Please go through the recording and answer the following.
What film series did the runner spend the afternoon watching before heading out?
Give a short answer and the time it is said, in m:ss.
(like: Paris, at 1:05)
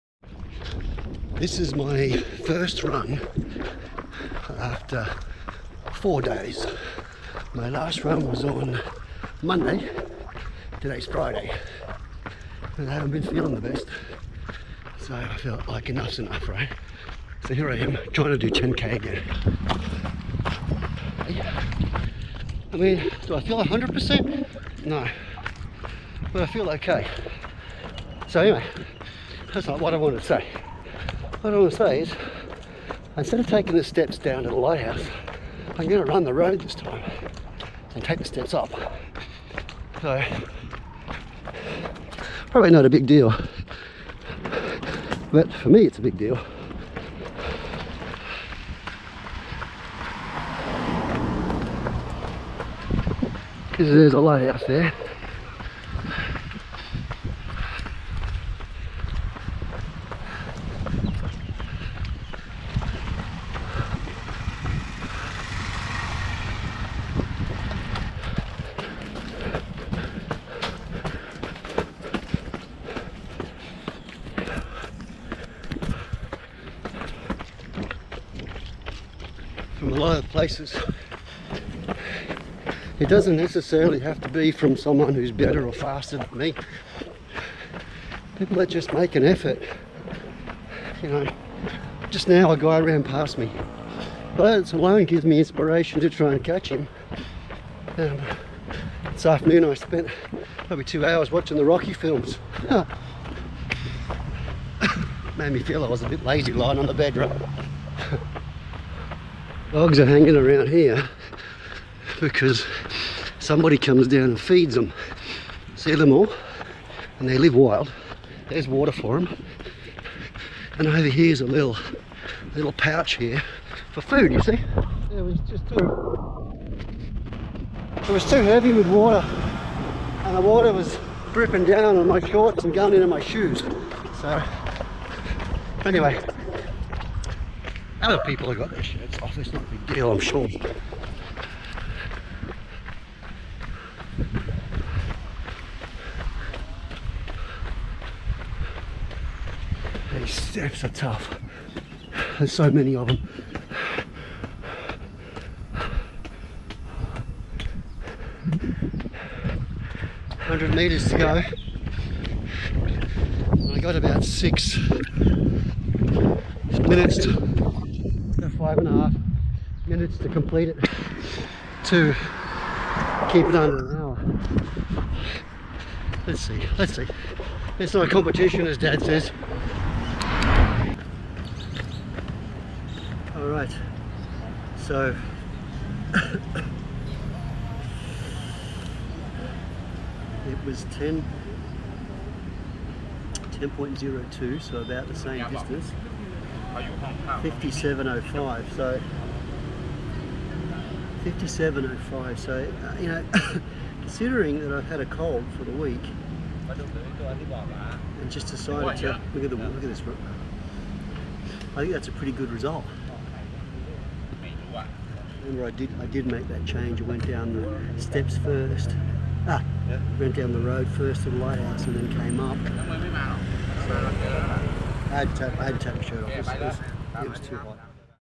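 Rocky, at 1:41.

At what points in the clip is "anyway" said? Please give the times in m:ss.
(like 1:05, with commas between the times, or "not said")
0:28, 2:15.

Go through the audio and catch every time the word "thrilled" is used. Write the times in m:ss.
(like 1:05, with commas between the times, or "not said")
not said.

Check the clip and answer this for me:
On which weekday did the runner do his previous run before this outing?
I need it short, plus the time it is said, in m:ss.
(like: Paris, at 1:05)
Monday, at 0:09.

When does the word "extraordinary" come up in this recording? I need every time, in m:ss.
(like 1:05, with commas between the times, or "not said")
not said.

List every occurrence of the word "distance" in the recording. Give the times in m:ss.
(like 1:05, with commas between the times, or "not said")
3:15.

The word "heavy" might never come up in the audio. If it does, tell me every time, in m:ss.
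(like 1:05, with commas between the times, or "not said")
2:08.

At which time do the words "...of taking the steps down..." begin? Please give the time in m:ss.
0:33.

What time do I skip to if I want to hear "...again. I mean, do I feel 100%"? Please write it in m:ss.
0:18.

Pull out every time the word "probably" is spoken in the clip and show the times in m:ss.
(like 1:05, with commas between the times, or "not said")
0:42, 1:40.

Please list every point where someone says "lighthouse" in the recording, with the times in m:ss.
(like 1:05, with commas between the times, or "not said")
0:34, 0:54, 3:41.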